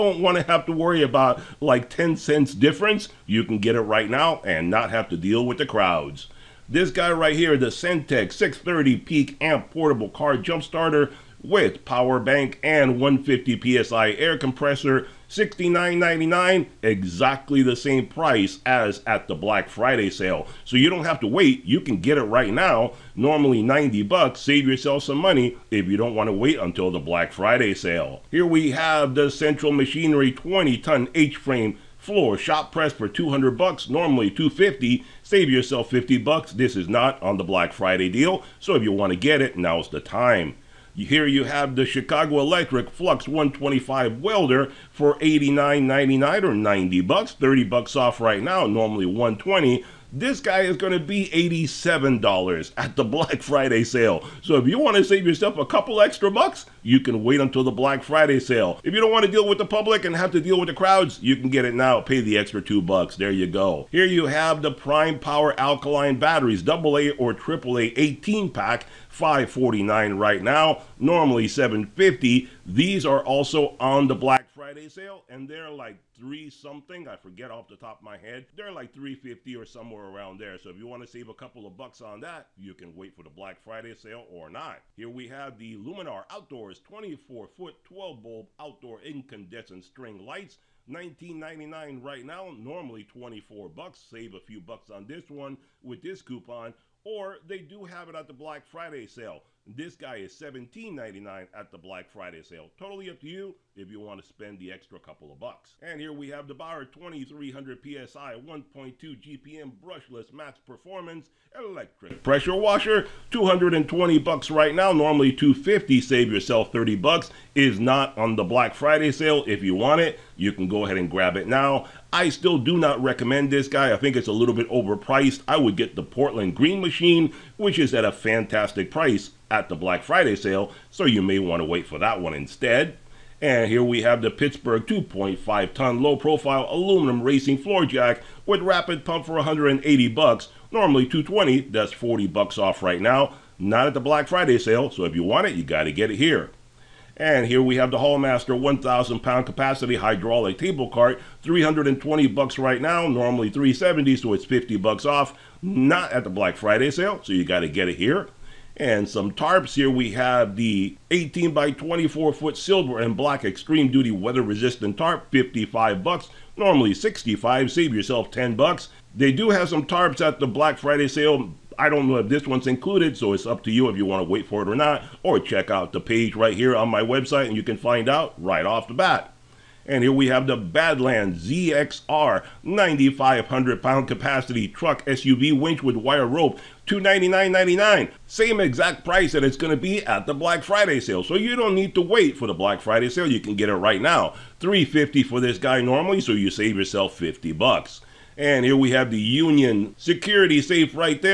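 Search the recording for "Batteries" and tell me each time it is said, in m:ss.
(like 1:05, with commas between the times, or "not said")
1:06.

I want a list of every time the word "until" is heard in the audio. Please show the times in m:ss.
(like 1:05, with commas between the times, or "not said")
0:26, 0:57.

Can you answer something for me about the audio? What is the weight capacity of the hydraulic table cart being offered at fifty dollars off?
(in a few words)
1,000 pounds.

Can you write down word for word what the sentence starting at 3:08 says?
Same exact price that it's going to be at the Black Friday sale.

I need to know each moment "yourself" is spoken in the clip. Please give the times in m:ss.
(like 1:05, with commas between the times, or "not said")
0:24, 0:35, 0:55, 1:56, 2:47, 3:16.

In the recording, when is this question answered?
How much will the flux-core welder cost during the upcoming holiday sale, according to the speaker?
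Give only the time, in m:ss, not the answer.
0:51.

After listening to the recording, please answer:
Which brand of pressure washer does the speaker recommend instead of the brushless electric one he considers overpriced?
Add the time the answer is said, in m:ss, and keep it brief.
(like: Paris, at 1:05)
Portland Green Machine, at 2:06.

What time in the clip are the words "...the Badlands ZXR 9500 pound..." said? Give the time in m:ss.
3:00.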